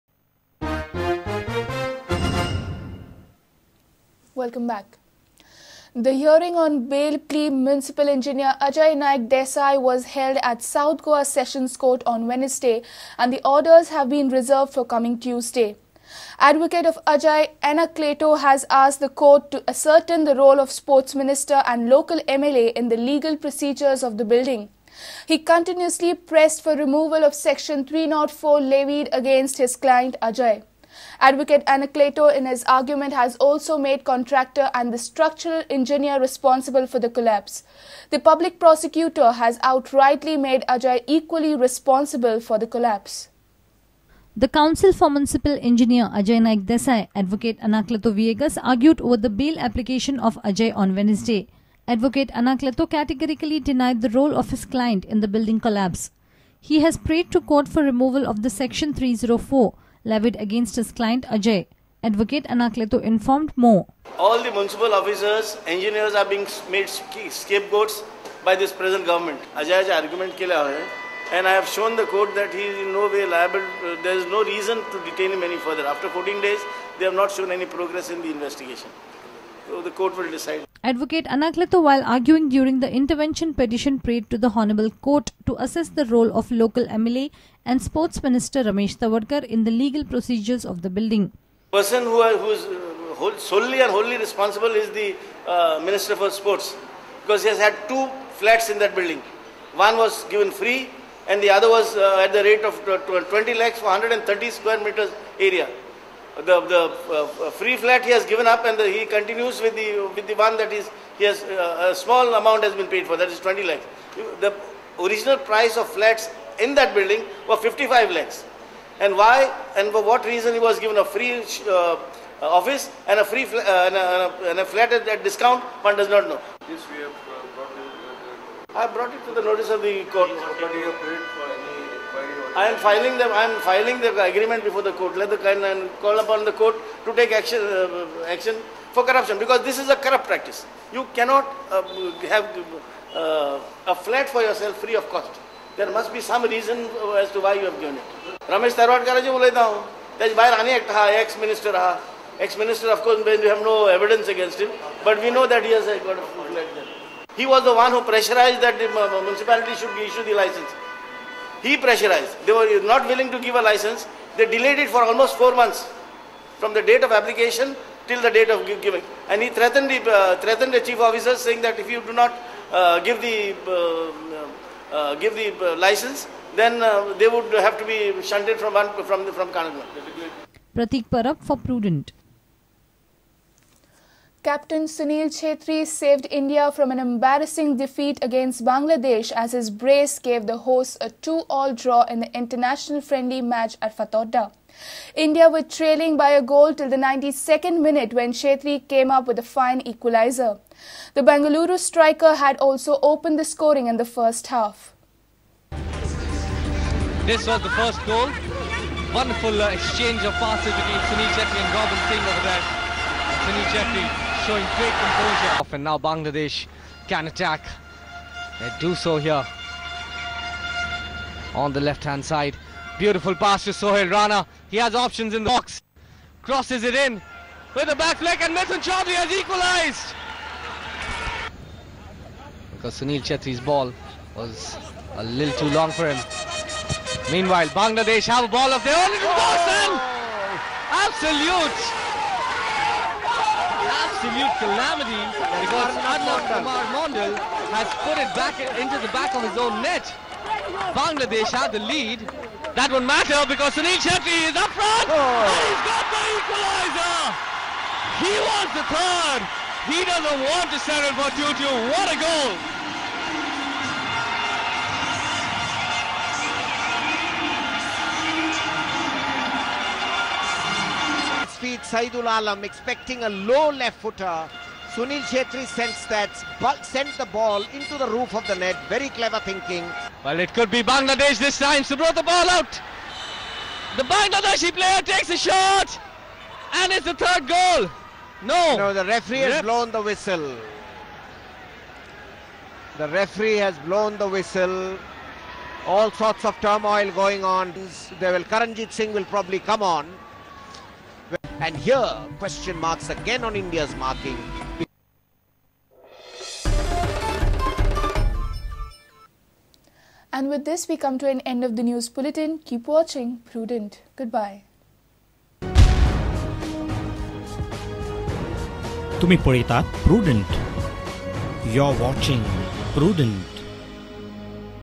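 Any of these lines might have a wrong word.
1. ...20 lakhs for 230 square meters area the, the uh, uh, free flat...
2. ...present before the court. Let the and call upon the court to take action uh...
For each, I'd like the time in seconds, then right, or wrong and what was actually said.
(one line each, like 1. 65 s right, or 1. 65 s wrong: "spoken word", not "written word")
1. 103 s wrong: "130", not "230"
2. 134 s wrong: "agreement", not "present".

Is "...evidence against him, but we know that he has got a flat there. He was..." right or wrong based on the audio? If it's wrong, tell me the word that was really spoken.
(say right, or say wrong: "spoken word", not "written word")
right.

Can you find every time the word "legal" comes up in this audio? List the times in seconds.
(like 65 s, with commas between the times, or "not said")
22 s, 89 s.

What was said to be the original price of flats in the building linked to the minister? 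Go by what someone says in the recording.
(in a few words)
55 lakhs.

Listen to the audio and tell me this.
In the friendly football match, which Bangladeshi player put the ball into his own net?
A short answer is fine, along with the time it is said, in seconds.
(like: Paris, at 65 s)
Adnan Kumar Mondal, at 246 s.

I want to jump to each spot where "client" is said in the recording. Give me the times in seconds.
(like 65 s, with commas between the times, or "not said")
29 s, 54 s, 60 s.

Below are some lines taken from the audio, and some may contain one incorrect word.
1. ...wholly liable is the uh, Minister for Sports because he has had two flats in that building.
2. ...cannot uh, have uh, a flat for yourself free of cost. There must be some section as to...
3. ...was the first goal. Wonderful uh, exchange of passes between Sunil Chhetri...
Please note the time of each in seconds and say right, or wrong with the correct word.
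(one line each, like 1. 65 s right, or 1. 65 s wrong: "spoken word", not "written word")
1. 93 s wrong: "responsible", not "liable"
2. 141 s wrong: "reason", not "section"
3. 207 s right.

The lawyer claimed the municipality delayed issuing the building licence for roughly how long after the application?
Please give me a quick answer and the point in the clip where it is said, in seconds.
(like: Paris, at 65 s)
four months, at 165 s.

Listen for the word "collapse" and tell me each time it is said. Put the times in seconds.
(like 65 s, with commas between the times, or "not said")
37 s, 42 s, 55 s.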